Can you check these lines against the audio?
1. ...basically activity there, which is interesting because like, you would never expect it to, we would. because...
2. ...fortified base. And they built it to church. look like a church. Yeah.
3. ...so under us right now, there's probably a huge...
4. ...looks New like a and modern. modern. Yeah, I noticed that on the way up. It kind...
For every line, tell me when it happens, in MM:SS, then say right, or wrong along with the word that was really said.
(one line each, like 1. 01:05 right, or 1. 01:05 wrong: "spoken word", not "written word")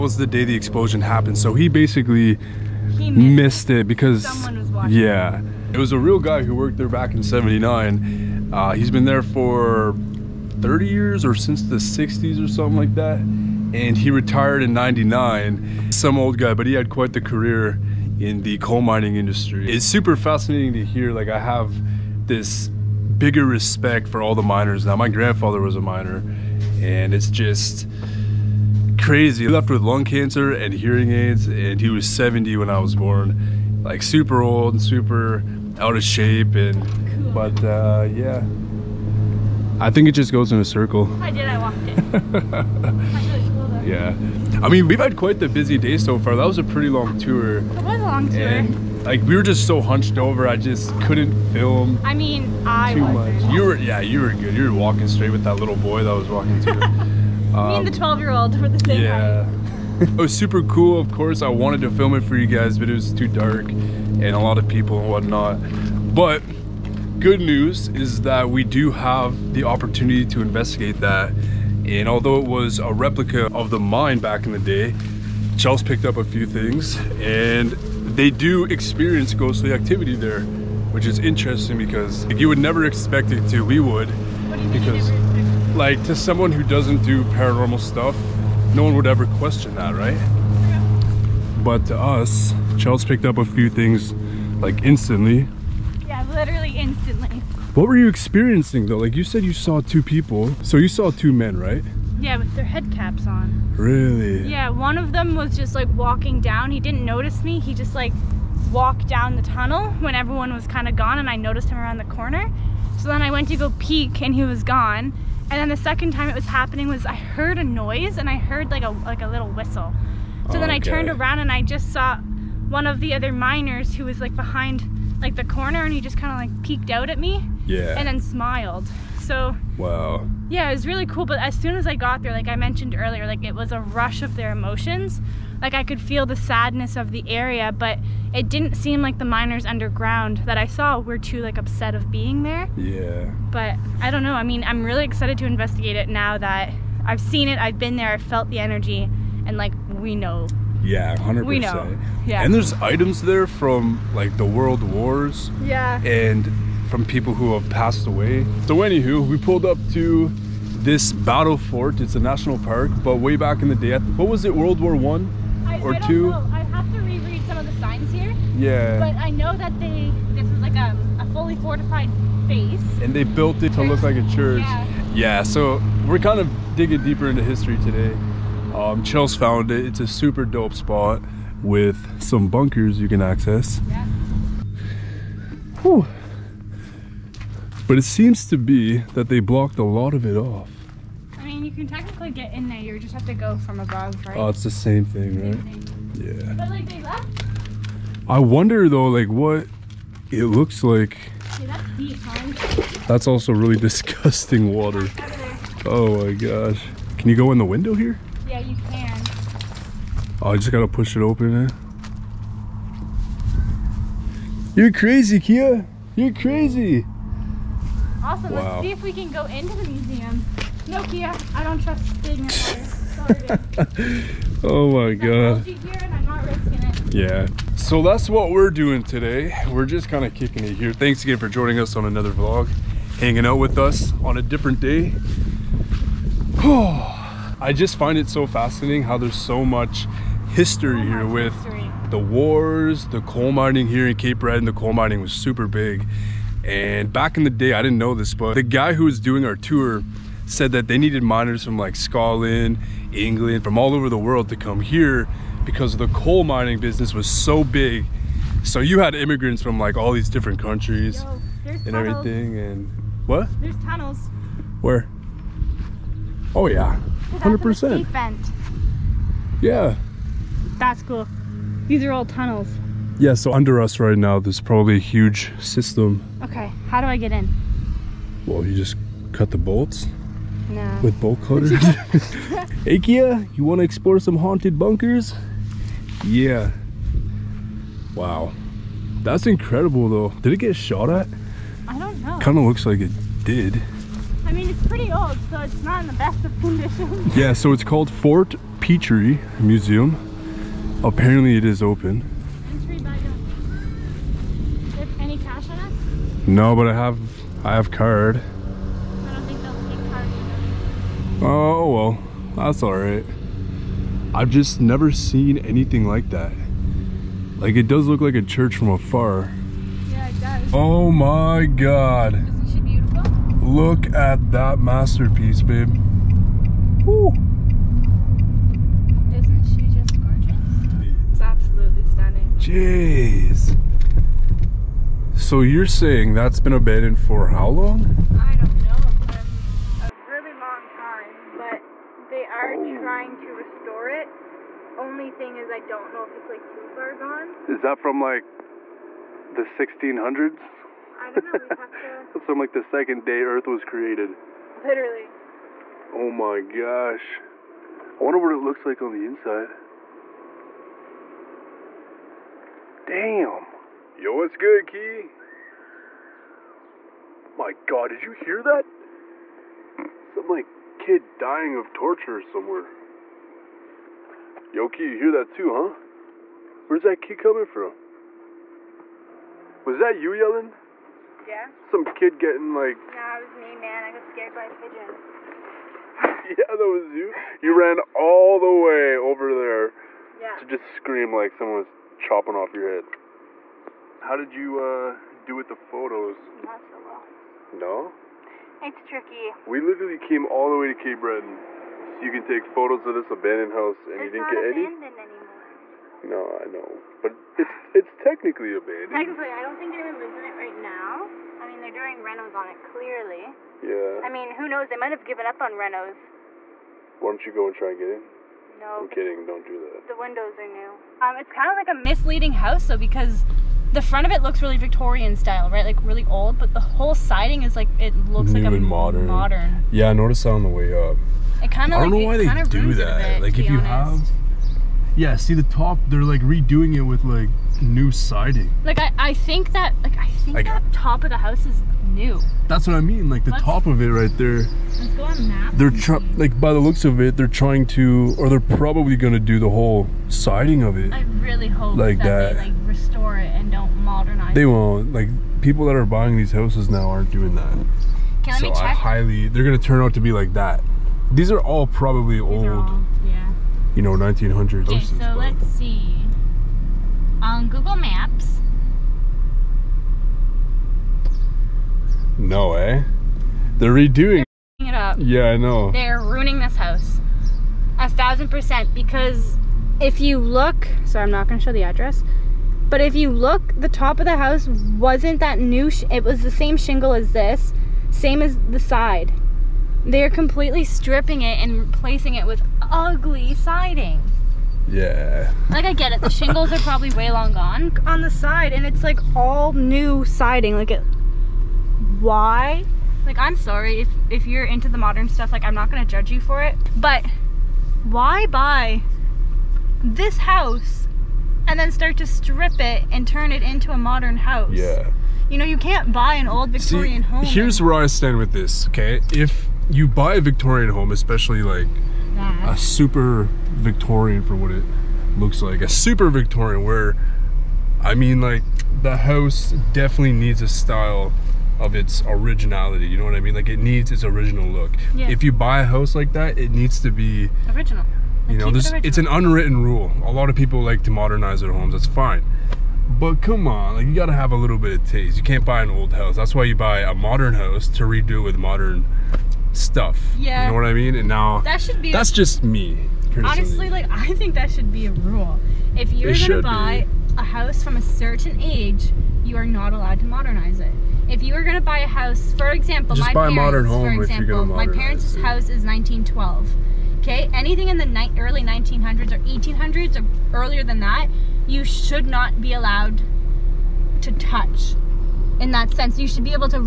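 1. 01:19 wrong: "ghostly", not "basically"
2. 02:51 right
3. 04:33 right
4. 07:08 right.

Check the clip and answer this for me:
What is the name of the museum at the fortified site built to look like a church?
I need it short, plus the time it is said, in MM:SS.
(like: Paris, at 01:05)
Fort Petrie Museum, at 04:58.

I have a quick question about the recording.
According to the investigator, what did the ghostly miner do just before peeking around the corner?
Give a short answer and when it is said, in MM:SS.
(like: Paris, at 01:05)
A little whistle, at 01:58.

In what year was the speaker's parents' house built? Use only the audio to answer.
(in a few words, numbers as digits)
1912.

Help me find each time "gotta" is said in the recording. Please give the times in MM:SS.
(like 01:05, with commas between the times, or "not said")
03:30, 09:04.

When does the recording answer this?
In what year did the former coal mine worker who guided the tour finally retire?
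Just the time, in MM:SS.
00:13.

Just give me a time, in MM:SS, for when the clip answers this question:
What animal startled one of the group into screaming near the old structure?
06:24.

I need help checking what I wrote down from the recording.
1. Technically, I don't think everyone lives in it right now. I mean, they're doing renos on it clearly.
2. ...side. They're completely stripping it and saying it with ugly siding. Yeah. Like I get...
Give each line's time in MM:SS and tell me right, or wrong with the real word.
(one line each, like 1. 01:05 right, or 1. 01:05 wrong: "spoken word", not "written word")
1. 06:49 wrong: "anyone", not "everyone"
2. 08:08 wrong: "replacing", not "saying".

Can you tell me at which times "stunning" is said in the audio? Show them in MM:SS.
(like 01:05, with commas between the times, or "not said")
05:32.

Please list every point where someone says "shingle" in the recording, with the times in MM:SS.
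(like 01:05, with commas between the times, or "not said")
08:06, 08:16.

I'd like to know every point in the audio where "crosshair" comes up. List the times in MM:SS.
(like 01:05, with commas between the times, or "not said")
not said.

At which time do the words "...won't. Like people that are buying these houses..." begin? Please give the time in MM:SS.
07:34.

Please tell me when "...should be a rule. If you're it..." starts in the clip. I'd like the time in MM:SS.
09:14.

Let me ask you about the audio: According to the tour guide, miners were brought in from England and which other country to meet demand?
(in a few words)
Scotland.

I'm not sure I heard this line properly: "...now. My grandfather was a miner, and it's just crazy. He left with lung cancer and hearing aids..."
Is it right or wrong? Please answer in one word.
right.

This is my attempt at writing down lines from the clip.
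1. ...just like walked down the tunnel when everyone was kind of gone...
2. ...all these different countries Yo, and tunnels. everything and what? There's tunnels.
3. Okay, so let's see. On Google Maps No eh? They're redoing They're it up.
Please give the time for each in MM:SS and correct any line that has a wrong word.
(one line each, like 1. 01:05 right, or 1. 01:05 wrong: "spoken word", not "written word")
1. 01:47 right
2. 04:19 right
3. 07:44 right.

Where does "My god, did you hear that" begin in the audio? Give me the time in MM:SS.
06:07.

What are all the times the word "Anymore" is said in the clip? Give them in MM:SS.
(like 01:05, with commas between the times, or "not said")
06:44.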